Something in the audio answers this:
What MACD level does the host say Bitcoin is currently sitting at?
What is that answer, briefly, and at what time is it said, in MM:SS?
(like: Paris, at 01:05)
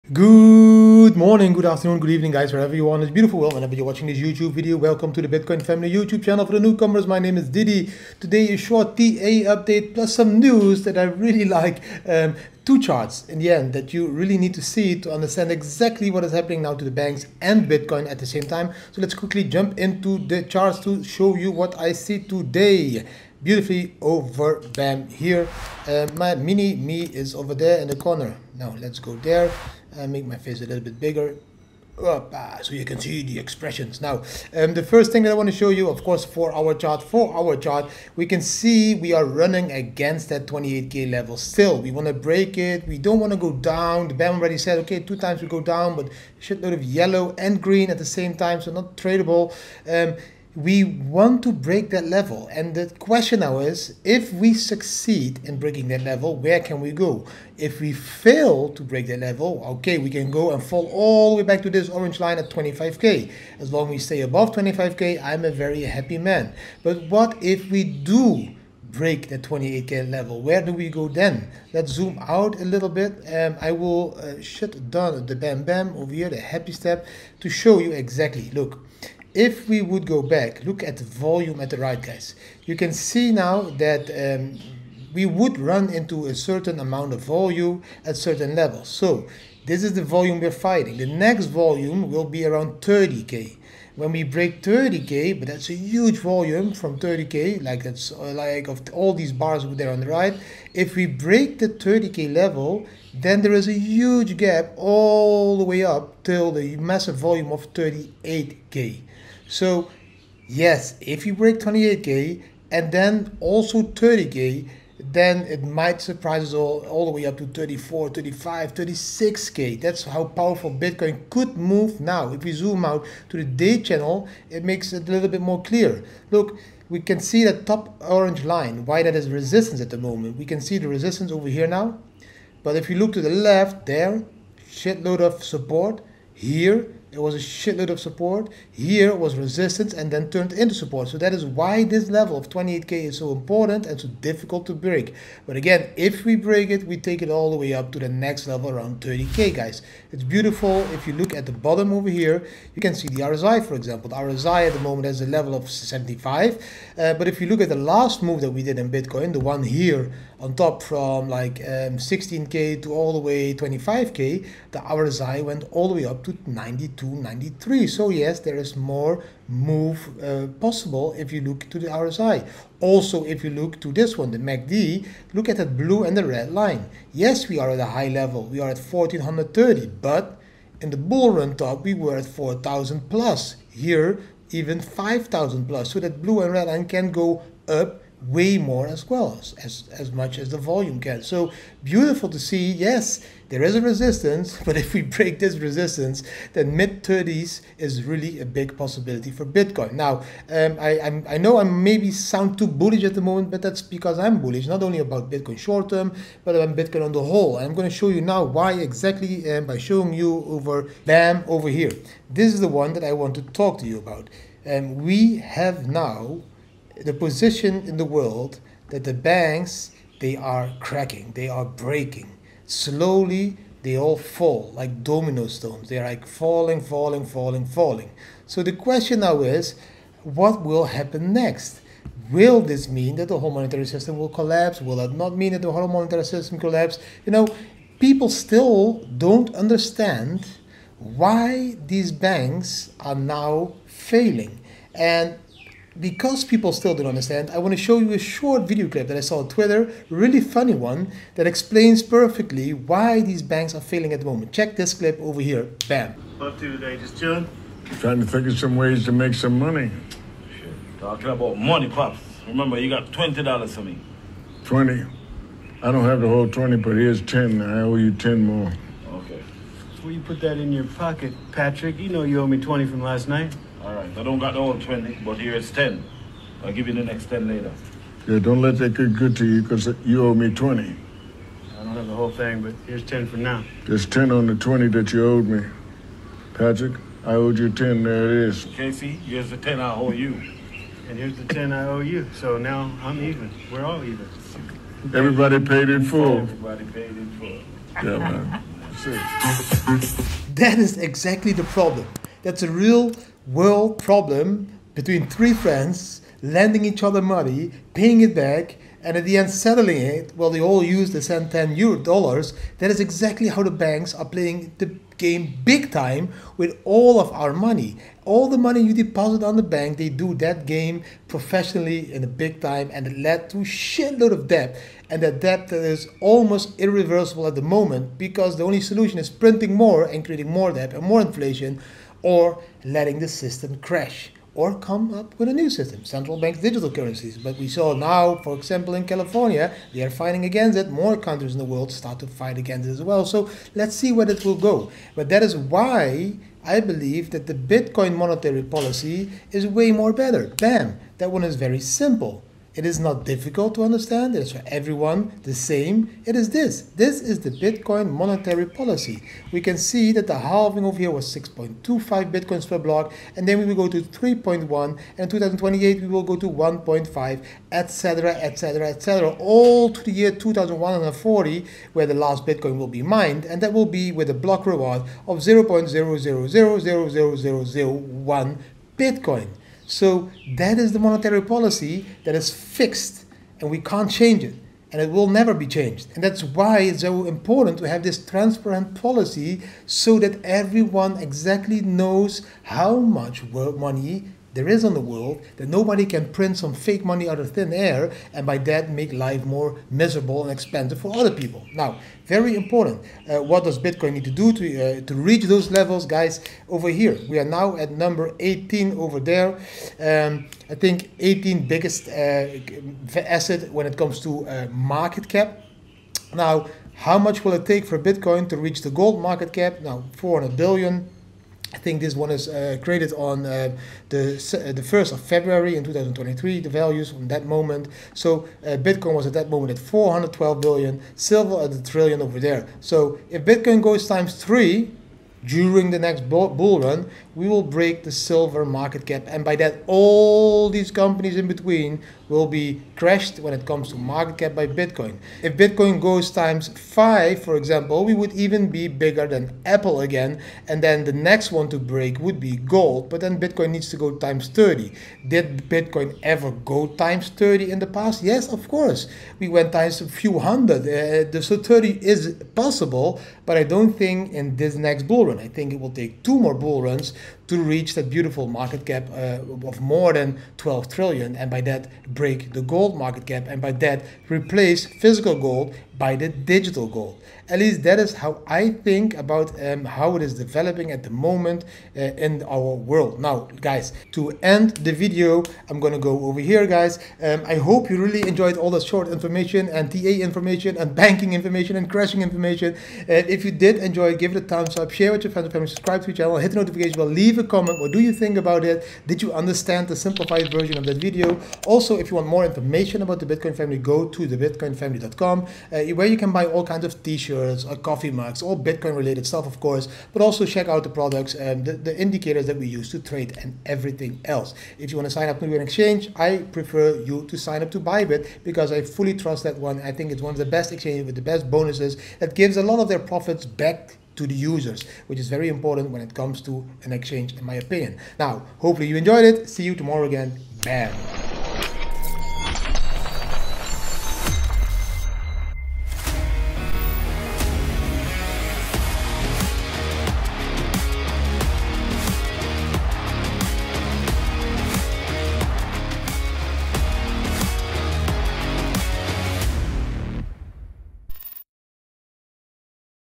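1430, at 02:58.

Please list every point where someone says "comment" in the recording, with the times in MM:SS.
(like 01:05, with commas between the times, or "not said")
08:17.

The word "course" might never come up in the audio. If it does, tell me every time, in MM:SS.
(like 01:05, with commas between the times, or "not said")
00:36, 07:38, 08:29.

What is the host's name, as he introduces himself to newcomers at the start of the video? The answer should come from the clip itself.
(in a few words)
Didi.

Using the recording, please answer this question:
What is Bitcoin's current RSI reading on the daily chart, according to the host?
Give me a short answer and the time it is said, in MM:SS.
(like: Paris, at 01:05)
75, at 02:35.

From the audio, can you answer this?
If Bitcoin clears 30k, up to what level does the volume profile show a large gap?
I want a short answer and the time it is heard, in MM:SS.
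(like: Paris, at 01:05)
38k, at 01:47.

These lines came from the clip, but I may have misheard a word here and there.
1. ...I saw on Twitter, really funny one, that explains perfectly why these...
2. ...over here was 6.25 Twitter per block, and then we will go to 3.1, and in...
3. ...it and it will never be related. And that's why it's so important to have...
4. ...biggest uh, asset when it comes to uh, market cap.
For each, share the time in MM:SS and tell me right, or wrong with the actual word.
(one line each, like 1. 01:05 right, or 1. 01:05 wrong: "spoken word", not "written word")
1. 04:09 right
2. 06:00 wrong: "Bitcoins", not "Twitter"
3. 06:24 wrong: "changed", not "related"
4. 06:51 right.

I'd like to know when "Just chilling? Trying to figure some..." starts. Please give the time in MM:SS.
04:16.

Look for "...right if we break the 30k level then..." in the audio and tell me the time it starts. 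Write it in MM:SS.
01:40.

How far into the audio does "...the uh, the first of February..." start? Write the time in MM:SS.
07:04.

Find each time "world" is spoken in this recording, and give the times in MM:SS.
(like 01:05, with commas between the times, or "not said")
03:38, 05:03, 05:41, 06:35, 08:02.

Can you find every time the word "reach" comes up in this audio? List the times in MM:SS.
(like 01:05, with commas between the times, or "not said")
06:45, 06:58, 07:47.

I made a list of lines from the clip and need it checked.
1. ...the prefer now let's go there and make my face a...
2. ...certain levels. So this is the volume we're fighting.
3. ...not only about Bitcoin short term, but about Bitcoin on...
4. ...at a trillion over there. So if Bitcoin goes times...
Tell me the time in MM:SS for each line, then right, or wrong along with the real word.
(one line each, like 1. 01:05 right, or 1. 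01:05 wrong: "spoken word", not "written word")
1. 00:27 wrong: "corner", not "prefer"
2. 01:28 right
3. 03:24 right
4. 07:11 right.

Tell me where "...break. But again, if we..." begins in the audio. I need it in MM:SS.
02:24.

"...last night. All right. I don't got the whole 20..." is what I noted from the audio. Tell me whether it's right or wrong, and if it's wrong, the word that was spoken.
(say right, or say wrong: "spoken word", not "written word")
right.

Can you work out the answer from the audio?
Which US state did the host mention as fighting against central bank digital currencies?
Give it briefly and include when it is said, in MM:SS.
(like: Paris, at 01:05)
California, at 05:39.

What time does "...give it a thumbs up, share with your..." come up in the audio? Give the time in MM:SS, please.
08:14.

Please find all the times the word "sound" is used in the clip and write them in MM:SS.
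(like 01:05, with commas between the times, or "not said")
03:22.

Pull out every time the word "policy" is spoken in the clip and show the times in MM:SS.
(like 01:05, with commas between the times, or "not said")
05:48, 05:58, 06:21, 06:28.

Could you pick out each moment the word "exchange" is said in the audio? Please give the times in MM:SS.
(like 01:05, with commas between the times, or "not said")
08:35, 08:40, 08:46.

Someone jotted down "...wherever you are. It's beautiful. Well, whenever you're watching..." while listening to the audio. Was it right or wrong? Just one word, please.
right.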